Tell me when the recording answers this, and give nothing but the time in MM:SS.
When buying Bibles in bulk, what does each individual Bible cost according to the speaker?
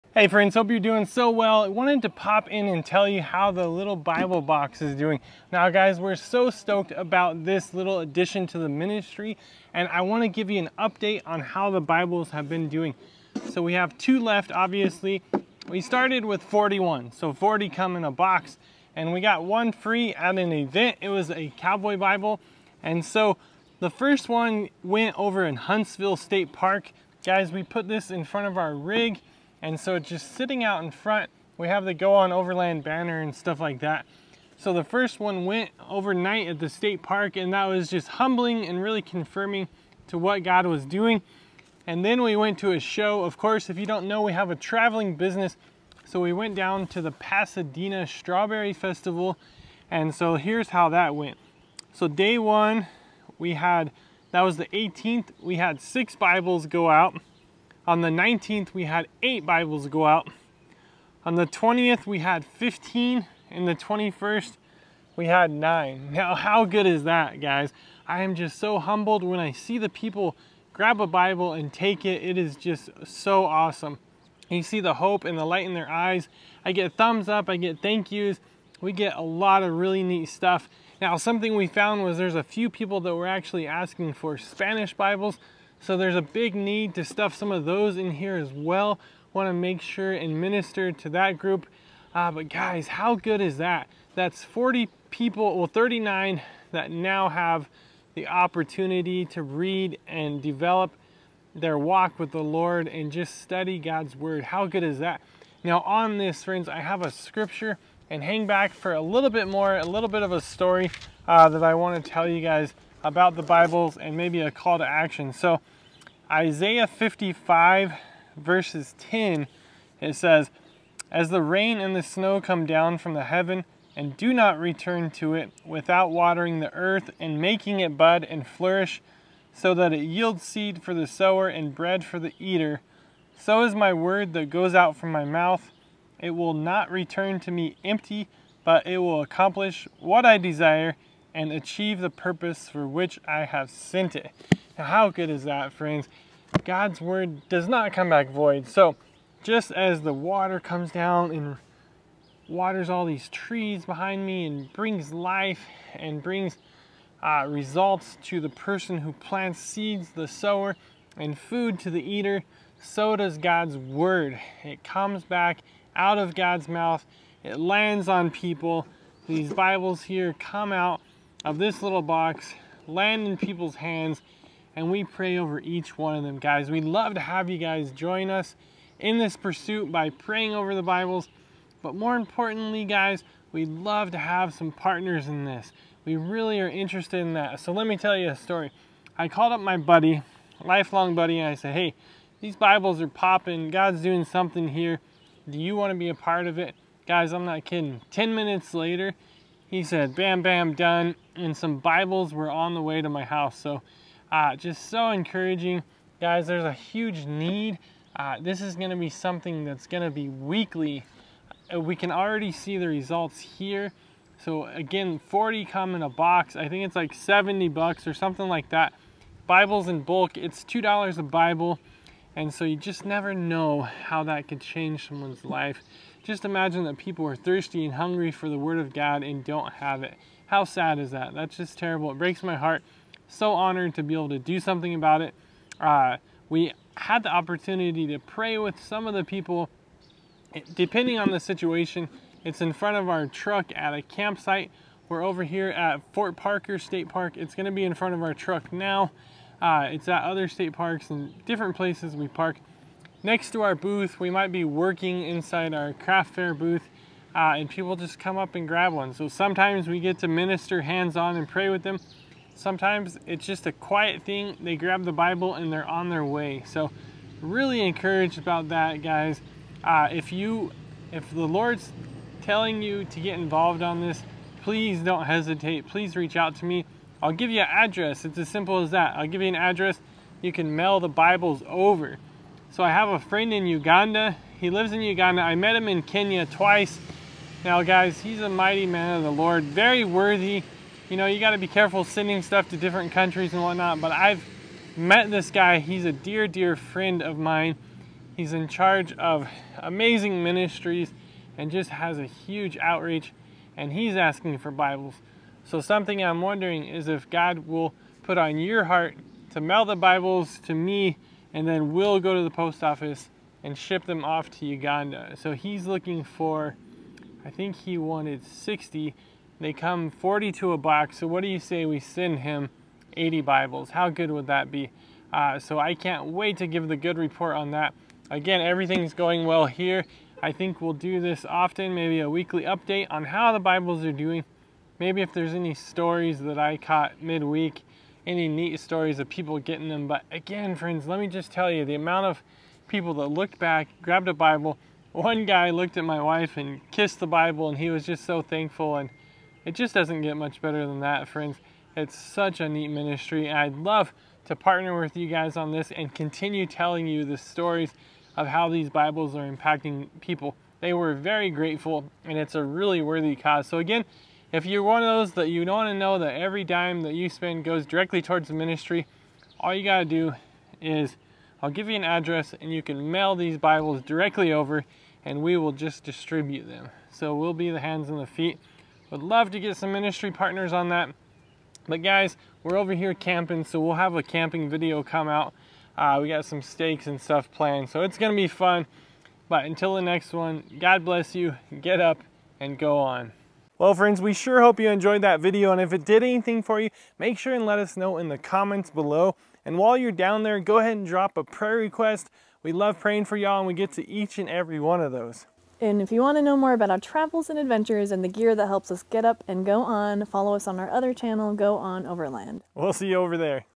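03:40.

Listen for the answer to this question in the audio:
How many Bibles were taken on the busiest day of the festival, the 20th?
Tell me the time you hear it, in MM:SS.
01:02.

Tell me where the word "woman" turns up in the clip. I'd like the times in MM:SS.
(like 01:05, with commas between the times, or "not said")
not said.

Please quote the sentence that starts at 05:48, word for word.
And it just doesn't get much better than that, friends.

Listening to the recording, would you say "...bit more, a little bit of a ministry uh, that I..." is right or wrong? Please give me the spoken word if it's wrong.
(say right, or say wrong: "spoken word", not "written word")
wrong: "story", not "ministry".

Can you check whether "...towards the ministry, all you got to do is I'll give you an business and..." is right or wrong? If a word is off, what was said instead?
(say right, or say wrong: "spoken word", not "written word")
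wrong: "address", not "business".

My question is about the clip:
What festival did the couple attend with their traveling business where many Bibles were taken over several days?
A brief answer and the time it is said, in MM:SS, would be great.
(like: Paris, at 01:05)
Pasadena Strawberry Festival, at 00:47.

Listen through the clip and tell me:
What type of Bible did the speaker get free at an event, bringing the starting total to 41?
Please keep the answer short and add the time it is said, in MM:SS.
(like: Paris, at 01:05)
Cowboy Bible, at 00:21.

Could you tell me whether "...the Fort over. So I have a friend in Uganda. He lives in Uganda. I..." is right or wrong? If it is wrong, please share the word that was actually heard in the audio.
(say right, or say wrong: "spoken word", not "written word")
wrong: "Bibles", not "Fort".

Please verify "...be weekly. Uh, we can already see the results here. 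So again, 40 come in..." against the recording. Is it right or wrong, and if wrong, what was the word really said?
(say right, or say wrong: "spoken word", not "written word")
right.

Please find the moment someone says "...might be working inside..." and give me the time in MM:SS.
04:14.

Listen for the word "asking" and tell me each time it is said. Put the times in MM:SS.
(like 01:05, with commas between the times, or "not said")
01:23, 05:04.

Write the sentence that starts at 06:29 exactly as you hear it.
But until the next one, God bless you, get up and go on.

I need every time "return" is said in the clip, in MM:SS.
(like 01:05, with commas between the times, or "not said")
02:04, 02:16.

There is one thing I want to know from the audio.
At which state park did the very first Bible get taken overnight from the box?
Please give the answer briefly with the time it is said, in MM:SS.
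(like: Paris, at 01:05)
Huntsville State Park, at 00:25.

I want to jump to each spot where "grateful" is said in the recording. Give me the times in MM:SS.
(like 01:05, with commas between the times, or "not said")
06:01.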